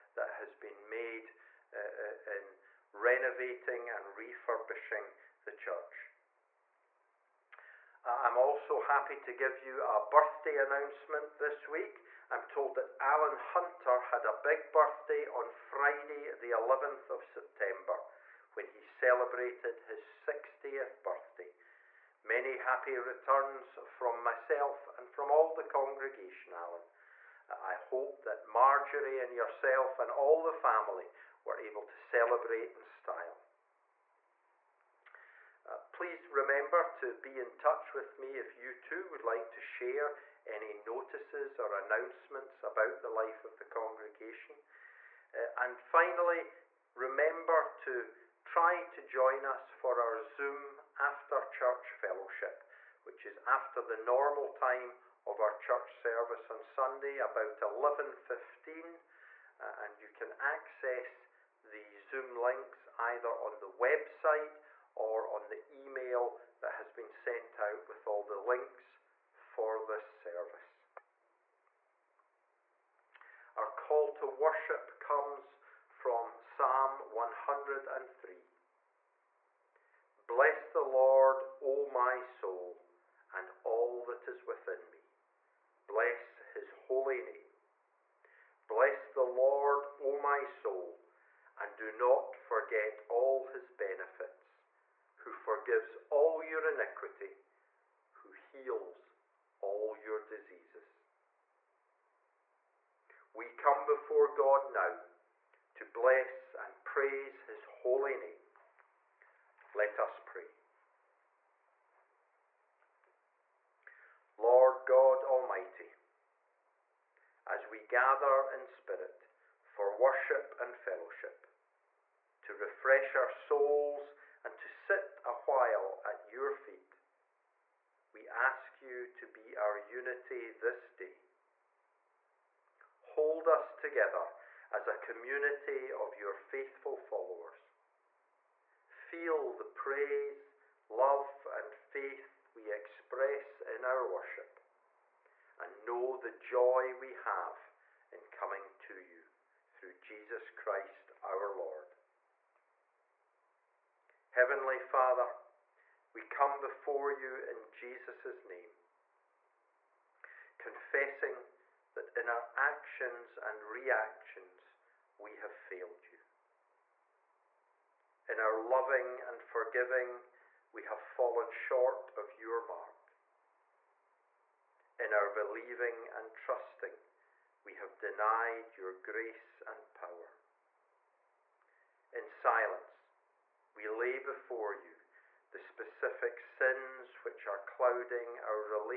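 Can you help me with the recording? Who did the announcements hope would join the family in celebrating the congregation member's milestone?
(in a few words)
Marjorie.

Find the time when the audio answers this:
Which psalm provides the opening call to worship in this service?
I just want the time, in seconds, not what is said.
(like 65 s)
76 s.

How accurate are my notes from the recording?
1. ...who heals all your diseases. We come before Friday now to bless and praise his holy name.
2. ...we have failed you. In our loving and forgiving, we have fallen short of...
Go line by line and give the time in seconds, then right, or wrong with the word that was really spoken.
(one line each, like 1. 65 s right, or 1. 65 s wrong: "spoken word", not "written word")
1. 98 s wrong: "God", not "Friday"
2. 165 s right.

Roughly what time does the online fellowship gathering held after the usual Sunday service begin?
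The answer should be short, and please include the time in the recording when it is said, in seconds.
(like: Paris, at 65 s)
11.15, at 57 s.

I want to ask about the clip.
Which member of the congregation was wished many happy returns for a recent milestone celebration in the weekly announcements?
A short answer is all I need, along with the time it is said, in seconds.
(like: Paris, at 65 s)
Alan Hunter, at 13 s.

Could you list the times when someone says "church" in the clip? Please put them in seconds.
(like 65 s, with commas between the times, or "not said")
5 s, 51 s, 55 s.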